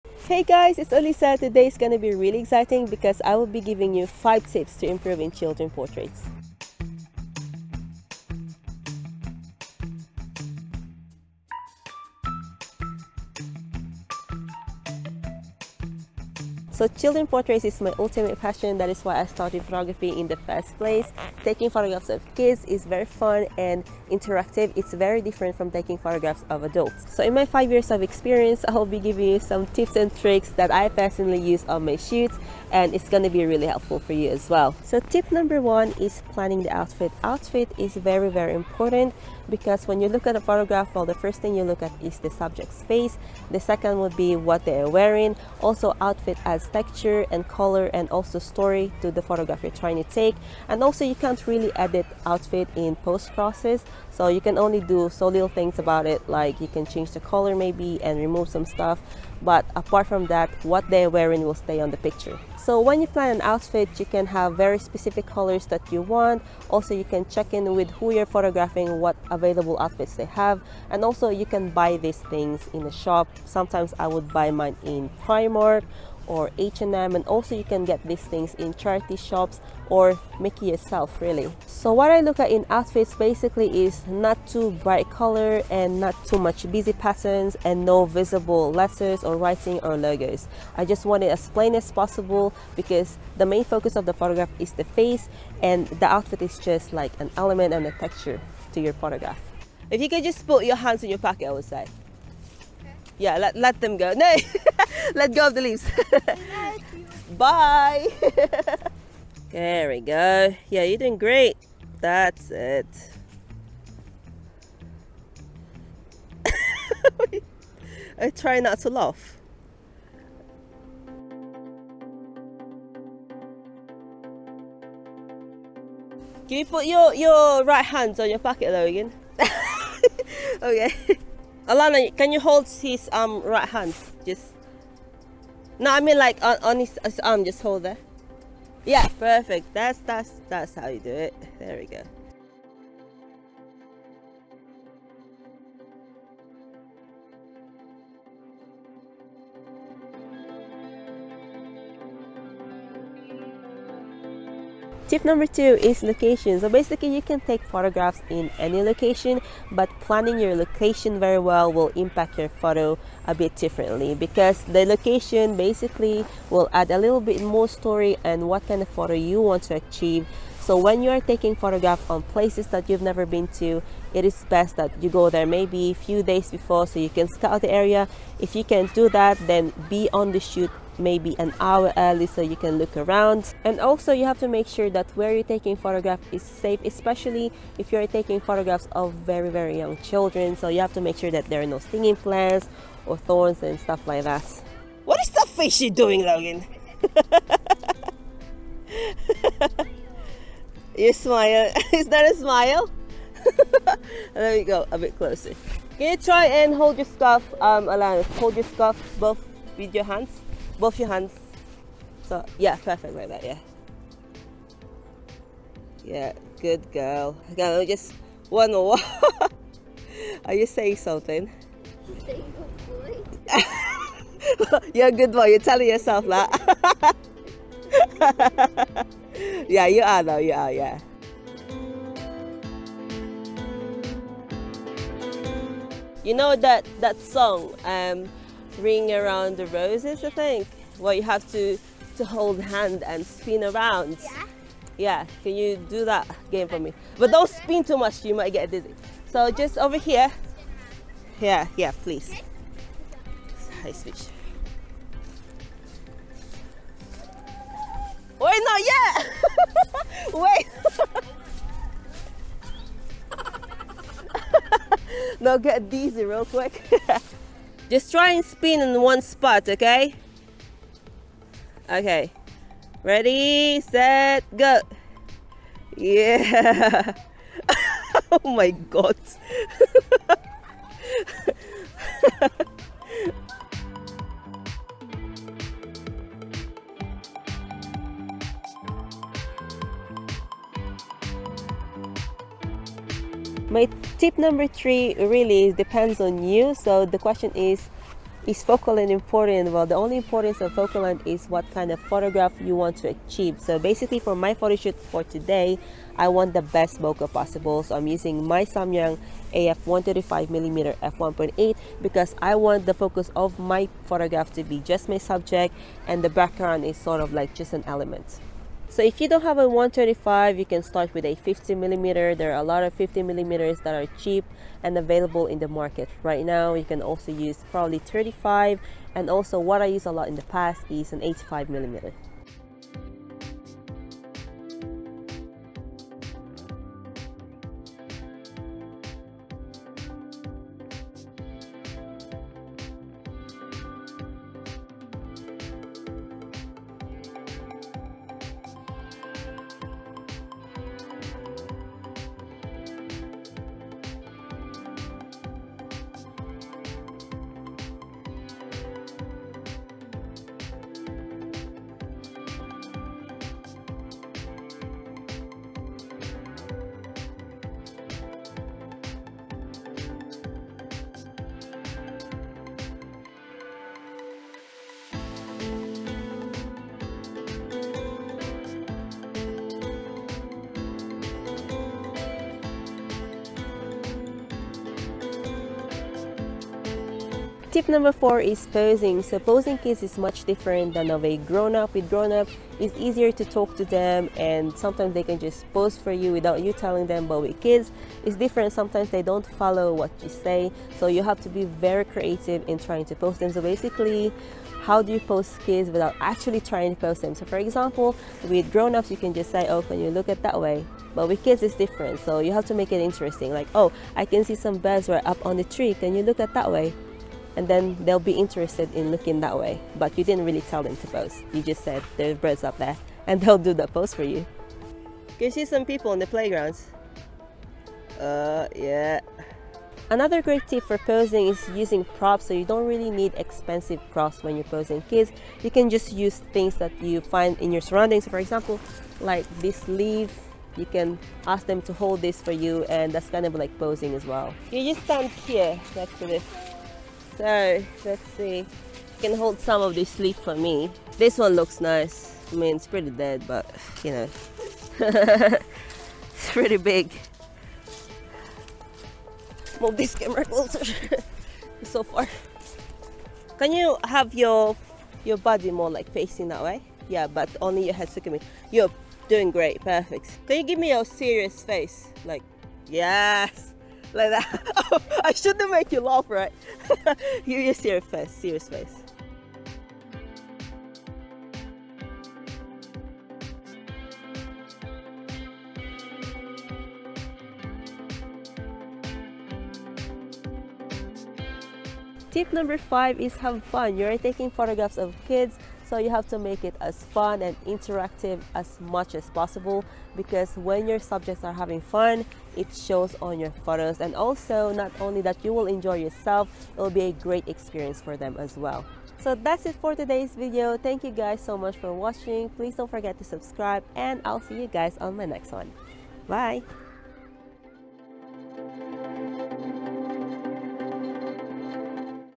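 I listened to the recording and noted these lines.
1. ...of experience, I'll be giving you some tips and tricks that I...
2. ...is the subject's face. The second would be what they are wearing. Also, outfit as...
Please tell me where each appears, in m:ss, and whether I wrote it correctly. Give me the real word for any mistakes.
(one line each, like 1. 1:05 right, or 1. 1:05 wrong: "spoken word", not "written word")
1. 0:27 right
2. 0:42 right.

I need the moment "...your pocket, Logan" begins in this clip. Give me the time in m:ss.
2:08.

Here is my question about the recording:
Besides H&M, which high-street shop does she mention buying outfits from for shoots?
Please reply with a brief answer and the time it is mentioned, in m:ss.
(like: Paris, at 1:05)
Primark, at 1:15.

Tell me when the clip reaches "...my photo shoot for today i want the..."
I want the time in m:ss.
5:04.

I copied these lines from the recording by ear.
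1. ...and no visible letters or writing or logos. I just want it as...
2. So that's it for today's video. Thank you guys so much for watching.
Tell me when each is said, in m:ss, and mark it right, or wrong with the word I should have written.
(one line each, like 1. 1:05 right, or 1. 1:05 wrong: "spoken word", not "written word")
1. 1:27 right
2. 8:29 right.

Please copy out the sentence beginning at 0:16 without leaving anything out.
So children portraits is my ultimate passion.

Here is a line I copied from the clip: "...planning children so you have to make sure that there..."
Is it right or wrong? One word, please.
wrong.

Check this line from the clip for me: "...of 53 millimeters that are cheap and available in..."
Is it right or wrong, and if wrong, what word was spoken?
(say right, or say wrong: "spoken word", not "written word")
wrong: "50", not "53".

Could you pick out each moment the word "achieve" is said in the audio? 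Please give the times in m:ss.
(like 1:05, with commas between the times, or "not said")
2:49, 5:03.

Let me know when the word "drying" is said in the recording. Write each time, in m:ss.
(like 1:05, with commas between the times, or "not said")
not said.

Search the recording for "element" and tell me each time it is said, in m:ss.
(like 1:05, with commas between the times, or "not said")
1:37, 5:17.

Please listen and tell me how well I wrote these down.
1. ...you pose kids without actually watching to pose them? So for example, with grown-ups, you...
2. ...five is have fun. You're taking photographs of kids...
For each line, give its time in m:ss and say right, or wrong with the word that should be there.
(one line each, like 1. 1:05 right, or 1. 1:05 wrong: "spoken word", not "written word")
1. 6:45 wrong: "trying", not "watching"
2. 8:12 right.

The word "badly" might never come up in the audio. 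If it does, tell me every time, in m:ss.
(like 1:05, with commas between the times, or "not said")
not said.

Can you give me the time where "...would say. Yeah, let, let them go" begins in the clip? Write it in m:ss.
1:41.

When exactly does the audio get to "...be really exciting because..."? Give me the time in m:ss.
0:01.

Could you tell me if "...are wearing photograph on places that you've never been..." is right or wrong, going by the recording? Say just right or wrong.
wrong.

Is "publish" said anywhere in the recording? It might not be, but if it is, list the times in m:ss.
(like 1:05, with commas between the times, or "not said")
not said.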